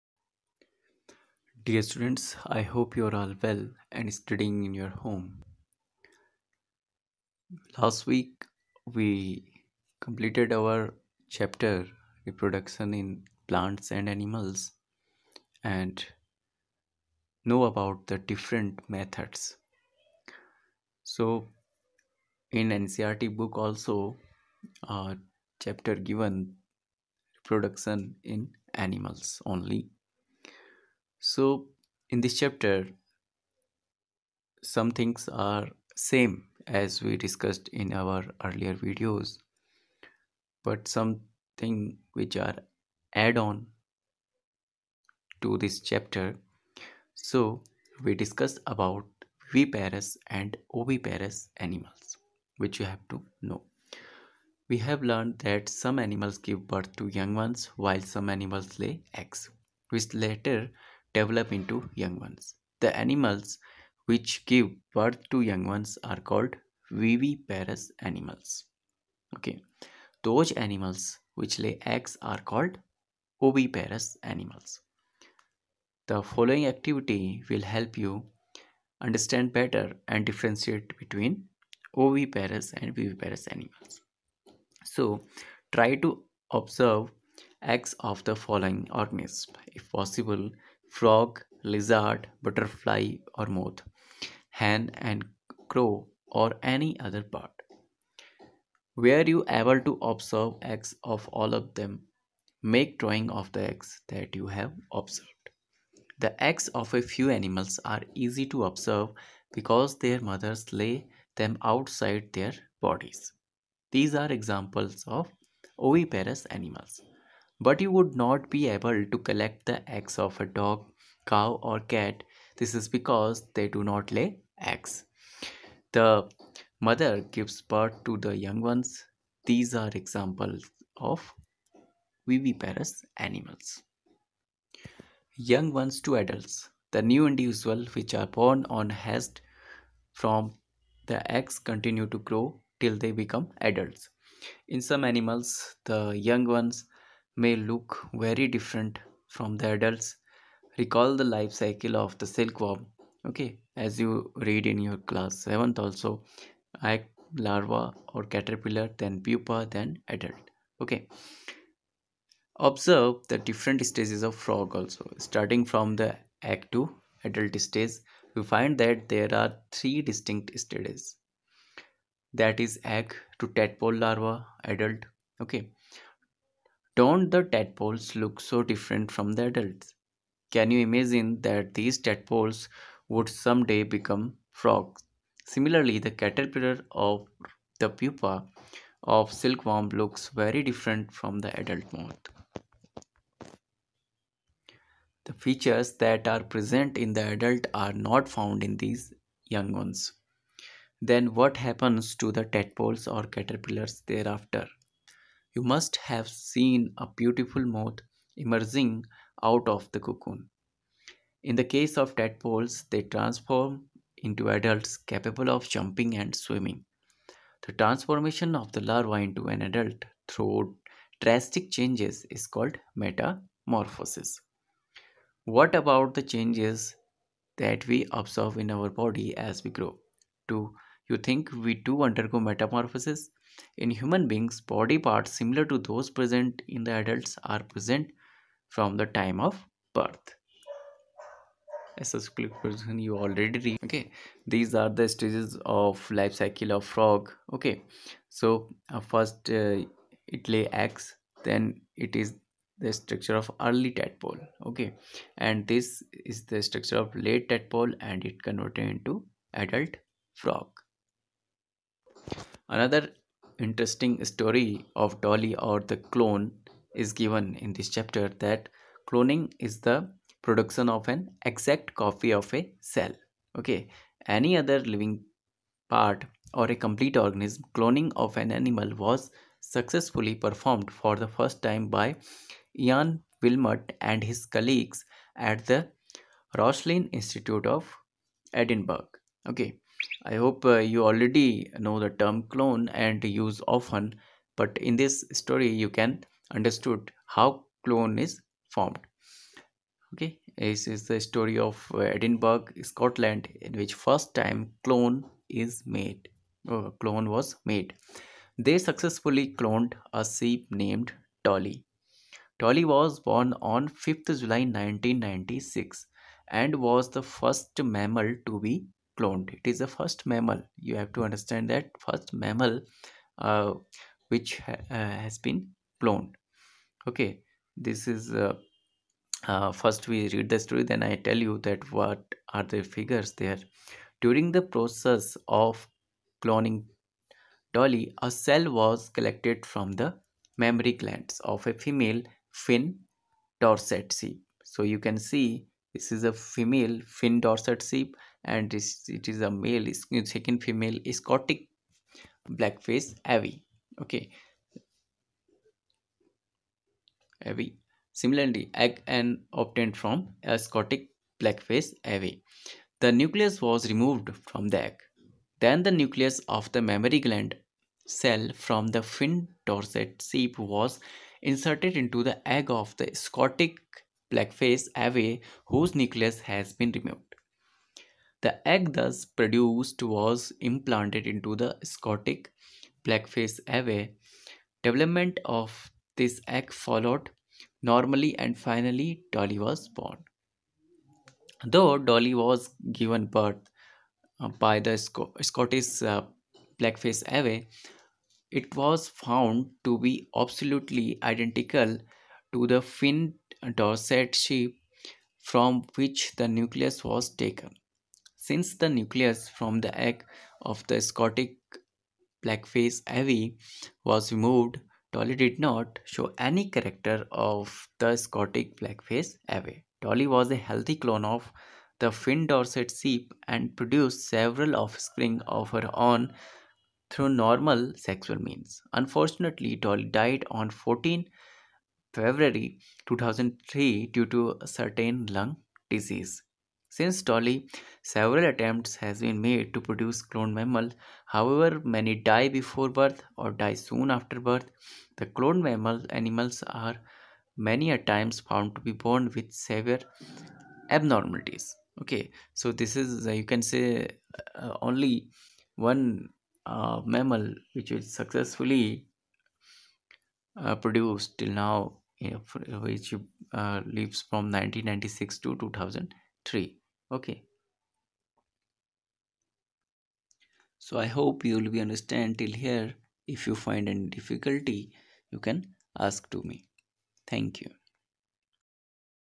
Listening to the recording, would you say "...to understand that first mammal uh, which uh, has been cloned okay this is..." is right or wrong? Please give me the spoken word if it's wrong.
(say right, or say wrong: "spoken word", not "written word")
right.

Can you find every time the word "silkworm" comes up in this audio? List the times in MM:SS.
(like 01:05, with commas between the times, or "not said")
02:32, 03:09.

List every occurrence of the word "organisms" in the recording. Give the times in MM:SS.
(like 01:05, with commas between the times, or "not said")
01:28, 04:37.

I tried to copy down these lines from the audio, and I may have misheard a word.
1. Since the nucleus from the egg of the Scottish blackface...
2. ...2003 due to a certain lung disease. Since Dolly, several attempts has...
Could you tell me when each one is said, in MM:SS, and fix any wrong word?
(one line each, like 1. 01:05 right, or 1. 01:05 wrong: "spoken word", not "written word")
1. 06:48 right
2. 07:13 right.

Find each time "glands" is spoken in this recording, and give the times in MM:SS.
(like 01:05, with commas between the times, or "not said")
05:40, 06:07.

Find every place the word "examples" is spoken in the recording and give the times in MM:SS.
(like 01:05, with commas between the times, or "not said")
01:54, 02:09.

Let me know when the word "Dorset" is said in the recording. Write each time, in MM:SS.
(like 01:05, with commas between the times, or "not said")
05:47, 06:09, 06:43, 07:02.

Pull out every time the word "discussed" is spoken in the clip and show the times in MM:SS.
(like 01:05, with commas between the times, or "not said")
00:37, 00:48.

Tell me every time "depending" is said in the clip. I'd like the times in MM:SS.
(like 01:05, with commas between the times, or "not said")
not said.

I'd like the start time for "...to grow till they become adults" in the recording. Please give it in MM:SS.
02:22.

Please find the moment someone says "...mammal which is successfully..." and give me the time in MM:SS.
07:37.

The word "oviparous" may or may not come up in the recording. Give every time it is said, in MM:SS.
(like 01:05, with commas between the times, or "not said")
00:50, 01:13, 01:21, 01:55.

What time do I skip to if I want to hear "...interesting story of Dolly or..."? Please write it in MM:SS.
04:23.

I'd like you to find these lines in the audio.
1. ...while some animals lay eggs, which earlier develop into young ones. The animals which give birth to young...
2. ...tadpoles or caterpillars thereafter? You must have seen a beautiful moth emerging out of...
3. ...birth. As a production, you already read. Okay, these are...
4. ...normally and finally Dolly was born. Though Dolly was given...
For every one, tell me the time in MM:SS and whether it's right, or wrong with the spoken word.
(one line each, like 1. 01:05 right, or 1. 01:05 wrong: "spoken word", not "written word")
1. 00:57 wrong: "later", not "earlier"
2. 03:22 right
3. 03:59 wrong: "person", not "production"
4. 06:27 right.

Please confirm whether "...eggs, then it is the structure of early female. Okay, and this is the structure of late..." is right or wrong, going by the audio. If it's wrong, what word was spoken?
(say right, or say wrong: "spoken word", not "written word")
wrong: "tadpole", not "female".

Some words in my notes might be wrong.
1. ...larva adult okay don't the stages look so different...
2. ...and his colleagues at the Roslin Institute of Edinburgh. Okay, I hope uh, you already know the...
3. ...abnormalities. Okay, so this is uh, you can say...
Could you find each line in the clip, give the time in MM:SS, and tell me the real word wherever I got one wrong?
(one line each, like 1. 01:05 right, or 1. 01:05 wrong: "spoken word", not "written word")
1. 02:53 wrong: "tadpoles", not "stages"
2. 04:44 right
3. 07:30 right.